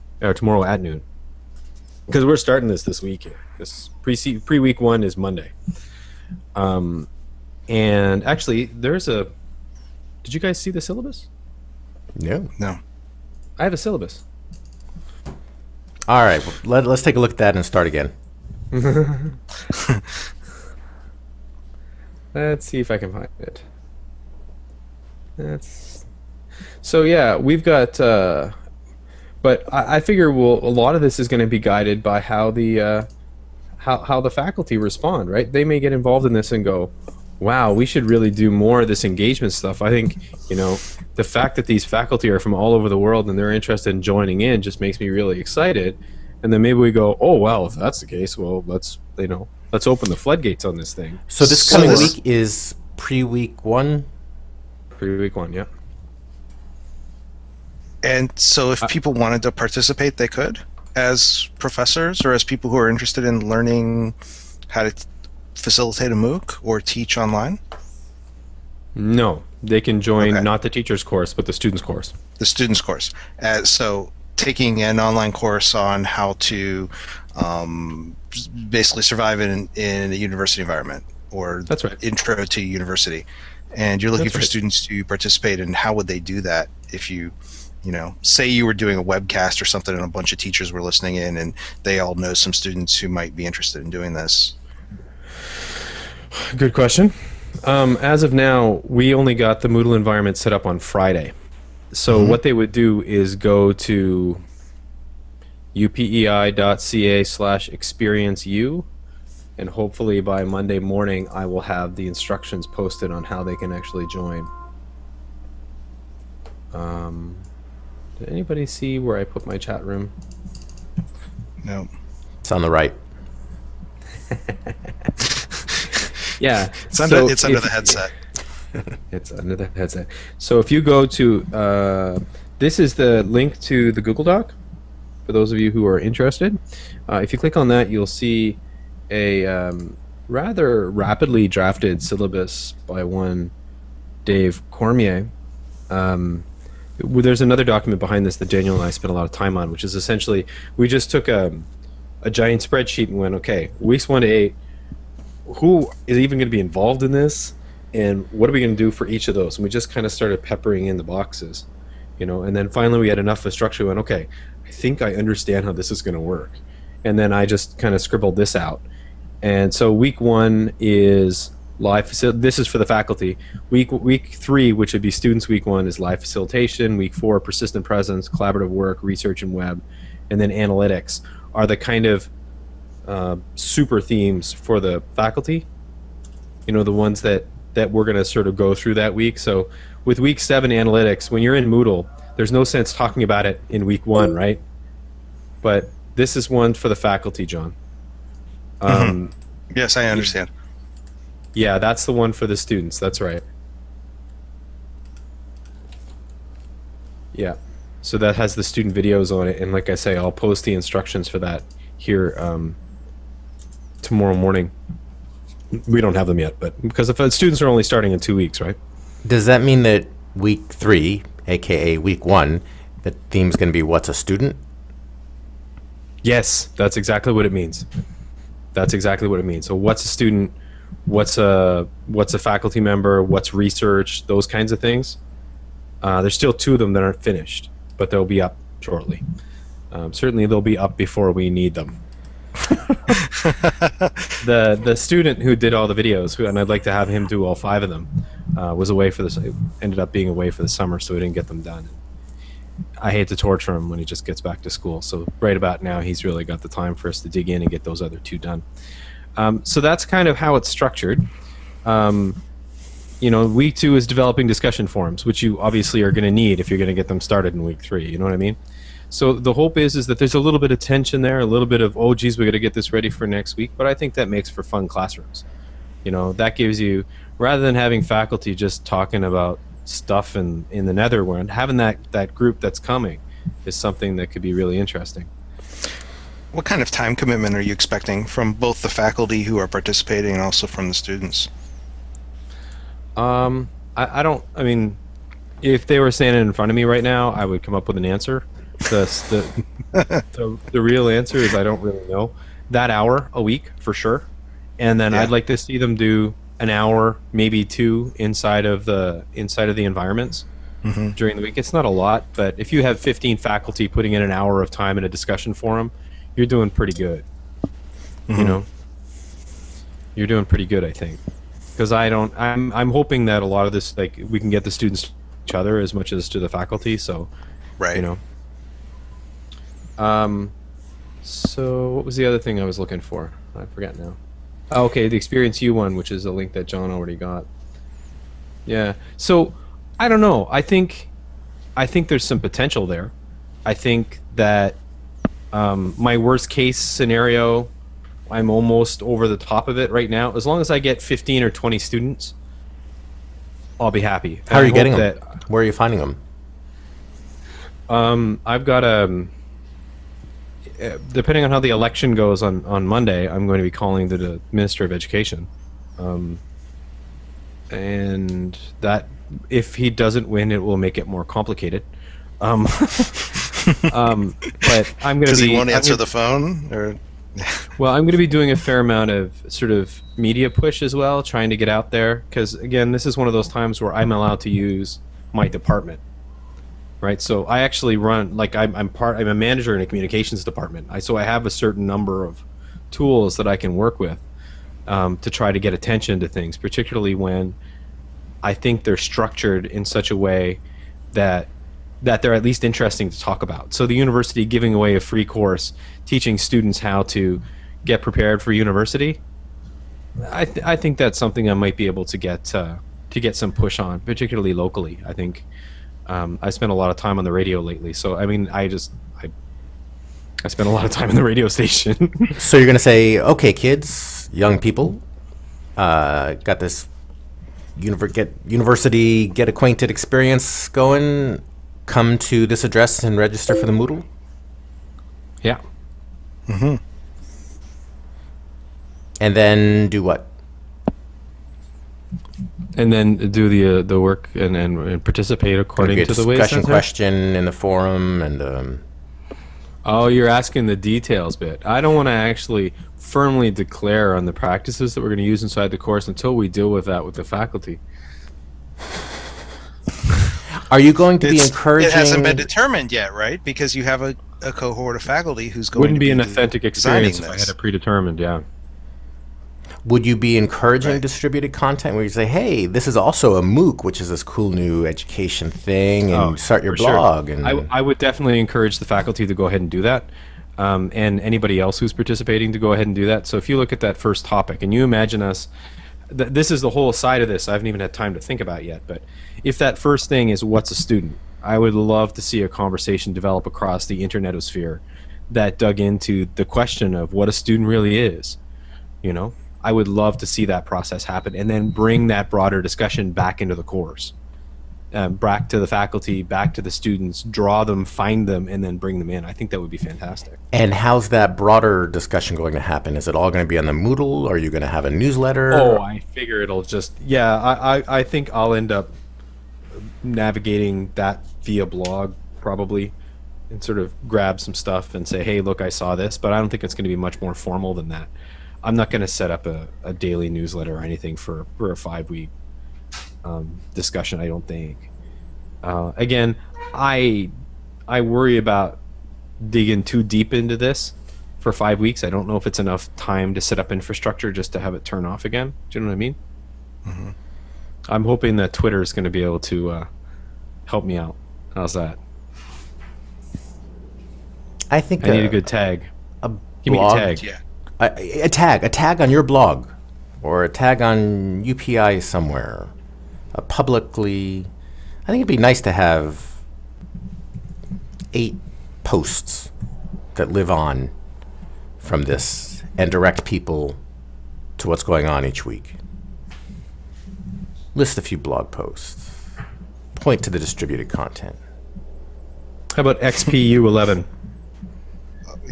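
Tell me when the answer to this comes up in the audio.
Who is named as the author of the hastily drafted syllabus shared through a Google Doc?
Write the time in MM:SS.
02:24.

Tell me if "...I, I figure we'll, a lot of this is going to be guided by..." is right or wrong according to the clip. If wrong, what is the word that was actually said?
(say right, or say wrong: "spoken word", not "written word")
right.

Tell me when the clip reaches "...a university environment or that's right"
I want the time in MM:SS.
01:20.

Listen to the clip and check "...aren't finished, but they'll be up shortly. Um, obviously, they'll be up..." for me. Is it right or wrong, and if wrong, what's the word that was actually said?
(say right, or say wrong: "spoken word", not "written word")
wrong: "certainly", not "obviously".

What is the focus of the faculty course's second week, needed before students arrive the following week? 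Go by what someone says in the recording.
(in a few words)
Developing discussion forums.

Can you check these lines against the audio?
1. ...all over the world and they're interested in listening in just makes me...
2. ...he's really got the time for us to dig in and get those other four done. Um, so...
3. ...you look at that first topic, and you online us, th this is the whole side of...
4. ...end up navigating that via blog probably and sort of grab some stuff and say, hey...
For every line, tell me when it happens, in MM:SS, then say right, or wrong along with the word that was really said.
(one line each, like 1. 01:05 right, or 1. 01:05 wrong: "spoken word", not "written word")
1. 00:42 wrong: "joining", not "listening"
2. 04:16 wrong: "two", not "four"
3. 08:03 wrong: "imagine", not "online"
4. 08:38 right.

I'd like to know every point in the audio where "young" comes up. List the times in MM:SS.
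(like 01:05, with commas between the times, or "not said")
07:04.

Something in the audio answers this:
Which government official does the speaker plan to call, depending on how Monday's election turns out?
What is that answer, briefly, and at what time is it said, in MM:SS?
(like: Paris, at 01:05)
Minister of Education, at 06:04.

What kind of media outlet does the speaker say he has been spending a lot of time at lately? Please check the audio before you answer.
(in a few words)
Radio station.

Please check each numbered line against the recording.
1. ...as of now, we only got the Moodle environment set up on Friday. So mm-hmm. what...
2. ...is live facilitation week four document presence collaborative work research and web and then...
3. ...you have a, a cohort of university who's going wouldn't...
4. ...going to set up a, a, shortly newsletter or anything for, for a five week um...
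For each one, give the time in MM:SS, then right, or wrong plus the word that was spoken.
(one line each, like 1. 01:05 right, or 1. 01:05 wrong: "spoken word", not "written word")
1. 01:38 right
2. 02:55 wrong: "persistent", not "document"
3. 07:43 wrong: "faculty", not "university"
4. 08:48 wrong: "daily", not "shortly".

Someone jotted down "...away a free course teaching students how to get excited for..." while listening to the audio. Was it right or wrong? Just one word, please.
wrong.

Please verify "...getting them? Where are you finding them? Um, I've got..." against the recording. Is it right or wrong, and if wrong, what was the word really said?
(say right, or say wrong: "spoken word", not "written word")
right.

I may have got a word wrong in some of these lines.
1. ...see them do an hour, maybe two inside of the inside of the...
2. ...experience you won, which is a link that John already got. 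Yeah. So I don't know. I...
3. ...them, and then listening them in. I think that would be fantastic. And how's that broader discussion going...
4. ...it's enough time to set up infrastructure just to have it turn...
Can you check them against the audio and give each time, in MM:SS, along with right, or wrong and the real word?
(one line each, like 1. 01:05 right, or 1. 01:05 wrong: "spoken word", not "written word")
1. 05:05 right
2. 05:35 right
3. 08:28 wrong: "bring", not "listening"
4. 09:02 right.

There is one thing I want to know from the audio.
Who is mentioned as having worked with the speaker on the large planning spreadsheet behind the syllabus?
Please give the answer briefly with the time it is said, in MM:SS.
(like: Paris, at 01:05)
Daniel, at 02:28.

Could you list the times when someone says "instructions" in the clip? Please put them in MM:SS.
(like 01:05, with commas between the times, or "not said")
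01:52, 03:30.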